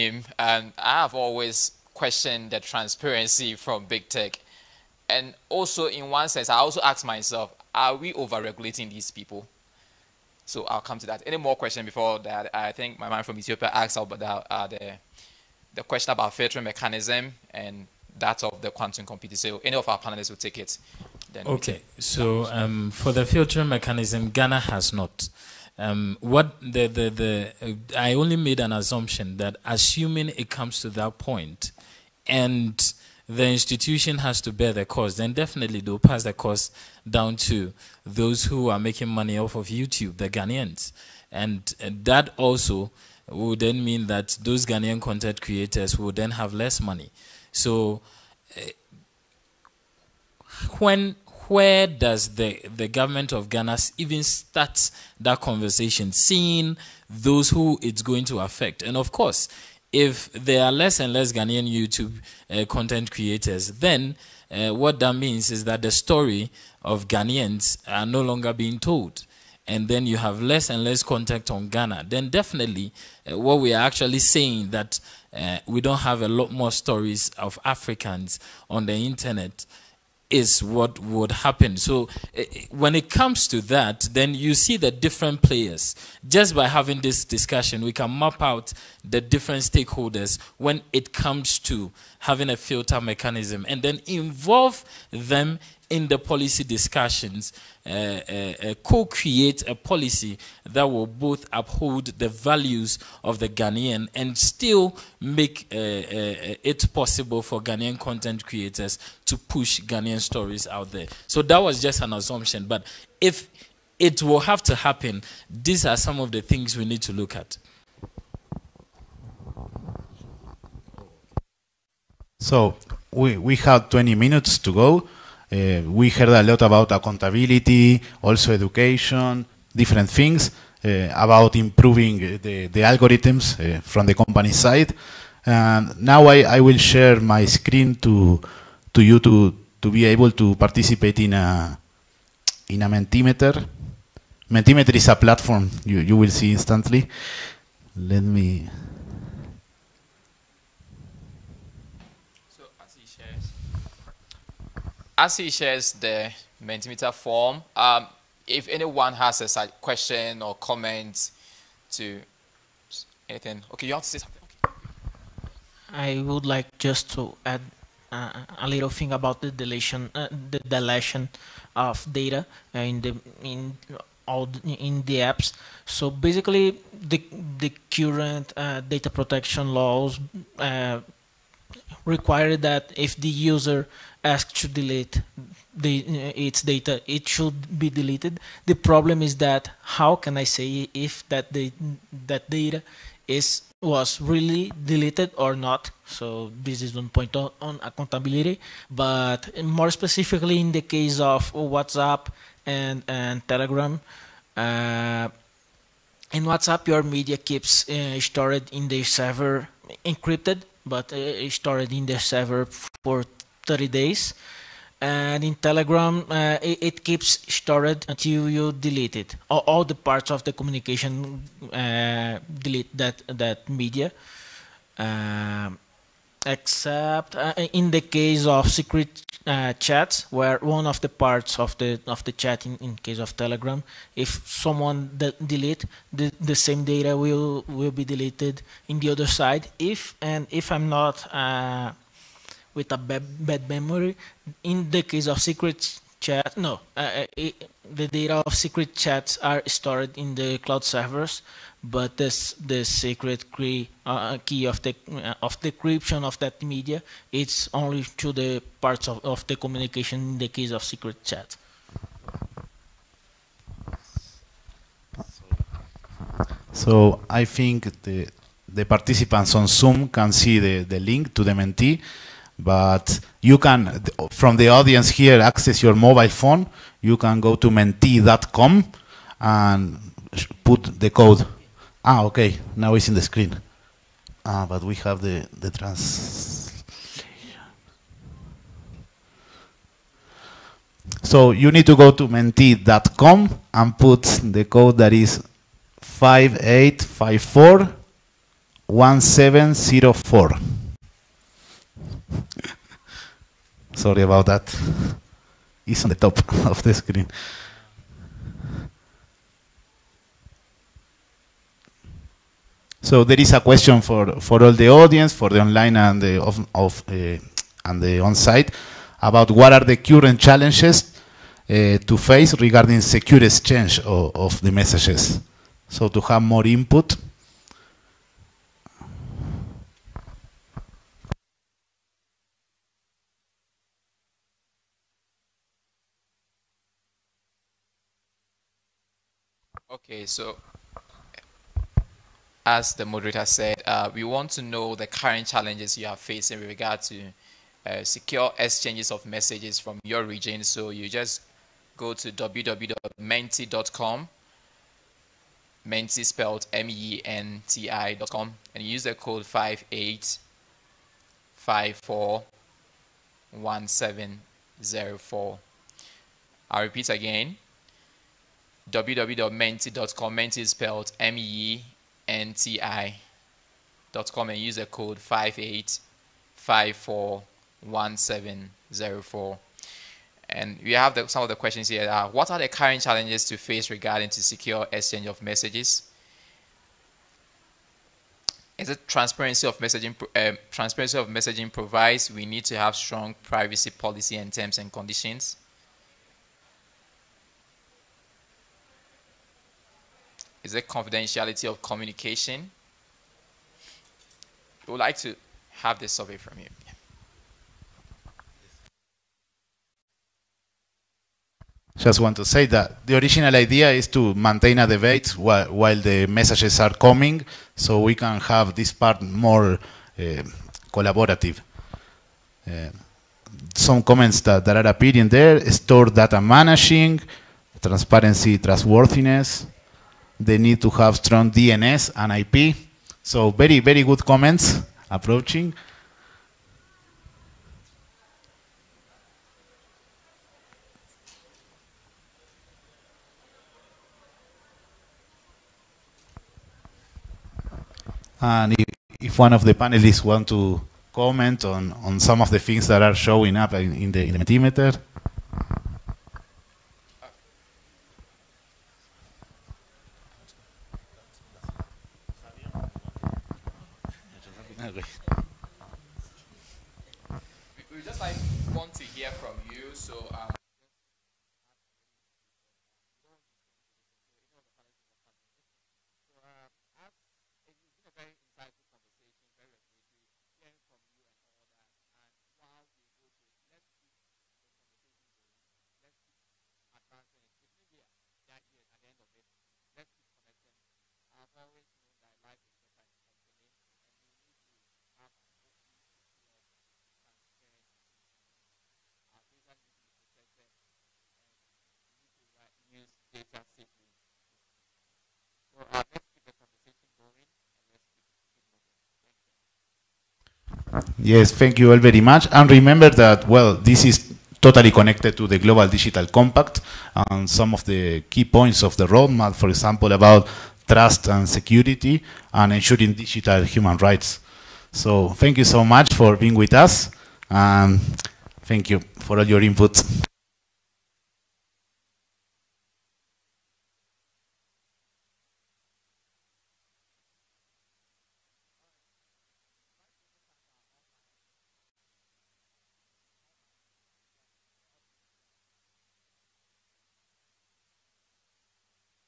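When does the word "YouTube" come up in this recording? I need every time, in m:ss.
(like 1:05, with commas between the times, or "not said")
0:39, 1:01.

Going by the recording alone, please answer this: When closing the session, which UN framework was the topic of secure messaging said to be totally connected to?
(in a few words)
Global Digital Compact.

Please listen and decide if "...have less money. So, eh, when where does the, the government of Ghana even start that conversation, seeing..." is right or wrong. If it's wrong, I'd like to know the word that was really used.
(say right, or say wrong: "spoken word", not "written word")
right.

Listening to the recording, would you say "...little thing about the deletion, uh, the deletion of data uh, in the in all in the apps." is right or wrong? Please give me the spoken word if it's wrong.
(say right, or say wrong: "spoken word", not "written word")
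right.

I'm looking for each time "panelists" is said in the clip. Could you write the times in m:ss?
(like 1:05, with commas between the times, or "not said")
0:19, 7:29.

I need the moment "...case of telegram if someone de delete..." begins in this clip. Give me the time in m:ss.
3:52.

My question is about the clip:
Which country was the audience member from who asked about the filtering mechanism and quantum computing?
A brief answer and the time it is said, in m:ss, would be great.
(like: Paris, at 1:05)
Ethiopia, at 0:13.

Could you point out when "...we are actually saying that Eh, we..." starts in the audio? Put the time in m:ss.
1:13.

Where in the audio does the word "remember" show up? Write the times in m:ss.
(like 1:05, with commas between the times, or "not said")
8:32.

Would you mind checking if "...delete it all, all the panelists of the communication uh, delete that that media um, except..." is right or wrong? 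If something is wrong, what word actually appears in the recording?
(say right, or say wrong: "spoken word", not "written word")
wrong: "parts", not "panelists".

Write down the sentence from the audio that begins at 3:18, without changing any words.
But more specifically, in the case of WhatsApp and and Telegram.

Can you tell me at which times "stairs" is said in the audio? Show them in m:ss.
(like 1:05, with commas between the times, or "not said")
not said.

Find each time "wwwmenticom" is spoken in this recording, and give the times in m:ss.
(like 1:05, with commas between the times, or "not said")
5:52, 6:08.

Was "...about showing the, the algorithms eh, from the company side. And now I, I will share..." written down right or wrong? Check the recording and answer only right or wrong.
wrong.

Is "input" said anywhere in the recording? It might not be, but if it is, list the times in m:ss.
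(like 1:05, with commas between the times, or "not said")
5:26, 8:49.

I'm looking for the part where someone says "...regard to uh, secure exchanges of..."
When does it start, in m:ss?
5:46.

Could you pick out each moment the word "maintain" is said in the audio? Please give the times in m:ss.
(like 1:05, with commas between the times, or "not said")
6:54.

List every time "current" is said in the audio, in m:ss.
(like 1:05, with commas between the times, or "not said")
2:57, 5:19, 5:45, 6:22.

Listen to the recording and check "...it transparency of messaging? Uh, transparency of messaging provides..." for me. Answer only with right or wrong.
right.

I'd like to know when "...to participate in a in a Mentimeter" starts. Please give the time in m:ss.
2:20.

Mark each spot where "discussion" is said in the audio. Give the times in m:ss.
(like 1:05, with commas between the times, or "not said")
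1:27, 1:36.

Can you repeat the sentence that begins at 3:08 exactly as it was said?
The problem is that how can I say if that the, that data is was really deleted or not?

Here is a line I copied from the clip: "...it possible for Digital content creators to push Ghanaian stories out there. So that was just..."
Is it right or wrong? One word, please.
wrong.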